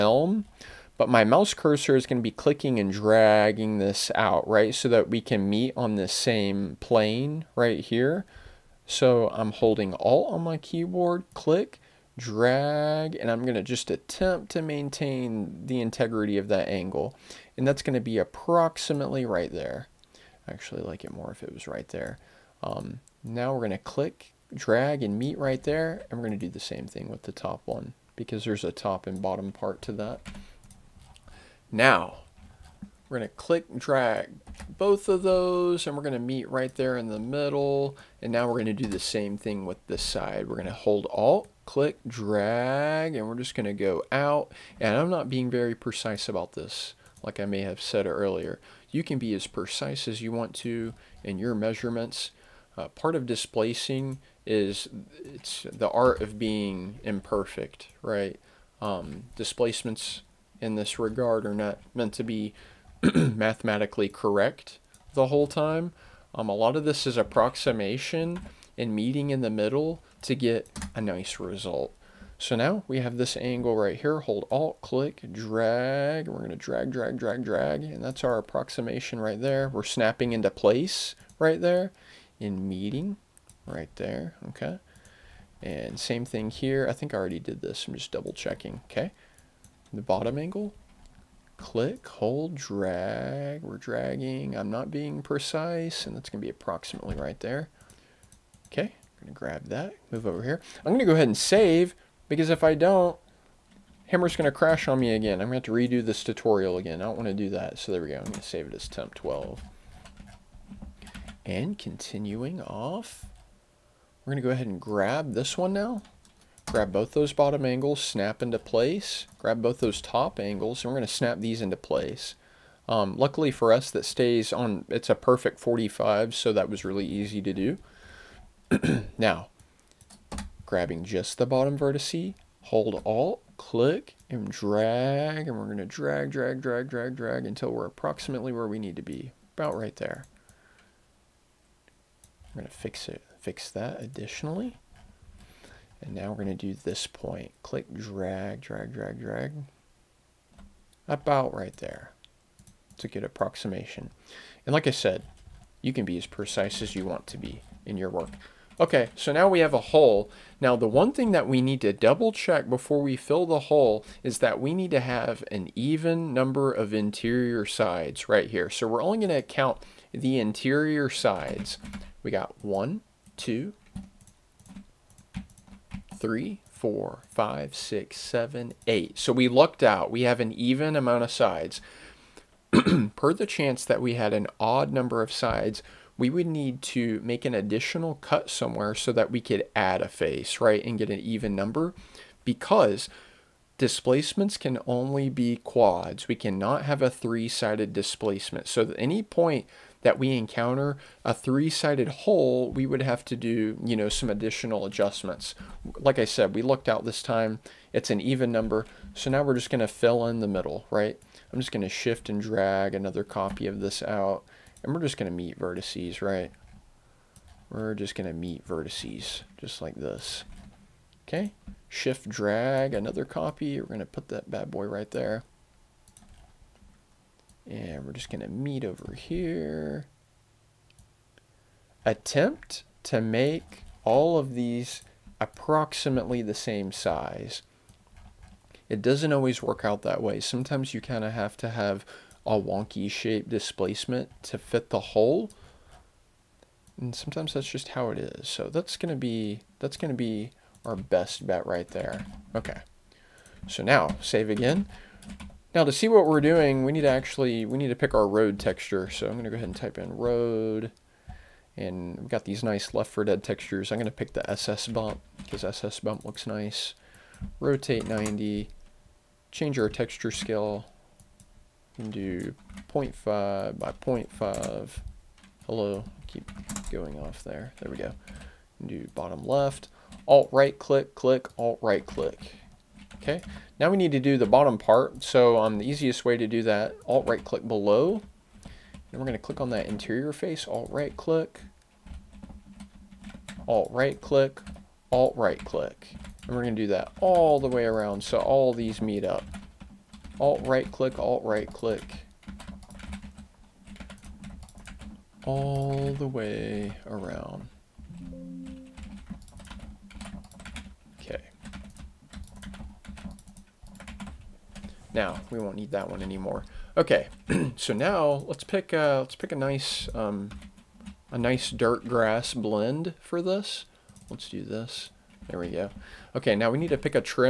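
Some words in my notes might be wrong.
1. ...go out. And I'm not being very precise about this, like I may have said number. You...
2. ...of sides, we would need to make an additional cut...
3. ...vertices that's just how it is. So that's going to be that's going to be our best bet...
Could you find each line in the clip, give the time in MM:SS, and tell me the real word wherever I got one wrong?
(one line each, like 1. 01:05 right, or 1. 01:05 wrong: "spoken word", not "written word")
1. 00:43 wrong: "earlier", not "number"
2. 03:05 right
3. 04:07 wrong: "sometimes", not "vertices".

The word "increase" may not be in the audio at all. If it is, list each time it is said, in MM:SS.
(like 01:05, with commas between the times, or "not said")
not said.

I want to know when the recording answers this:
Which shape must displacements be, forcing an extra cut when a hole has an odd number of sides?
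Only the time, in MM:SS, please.
03:15.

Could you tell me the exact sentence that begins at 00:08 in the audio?
So I'm holding Alt on my keyboard, click, drag, and I'm gonna just attempt to maintain the integrity of that angle.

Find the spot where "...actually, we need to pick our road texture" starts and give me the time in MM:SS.
04:17.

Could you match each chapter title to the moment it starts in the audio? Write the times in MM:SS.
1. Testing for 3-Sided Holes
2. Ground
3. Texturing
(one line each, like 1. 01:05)
1. 02:40
2. 03:28
3. 04:12.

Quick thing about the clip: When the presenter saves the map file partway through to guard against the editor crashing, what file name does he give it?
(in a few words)
temp 12.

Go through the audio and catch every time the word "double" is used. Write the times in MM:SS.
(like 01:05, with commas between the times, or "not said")
01:28, 02:41.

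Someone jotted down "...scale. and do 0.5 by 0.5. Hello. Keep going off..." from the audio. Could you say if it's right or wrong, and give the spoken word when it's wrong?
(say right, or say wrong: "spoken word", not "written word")
right.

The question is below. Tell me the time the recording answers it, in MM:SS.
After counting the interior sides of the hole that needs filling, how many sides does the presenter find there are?
02:58.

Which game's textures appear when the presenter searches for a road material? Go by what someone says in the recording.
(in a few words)
Left 4 Dead.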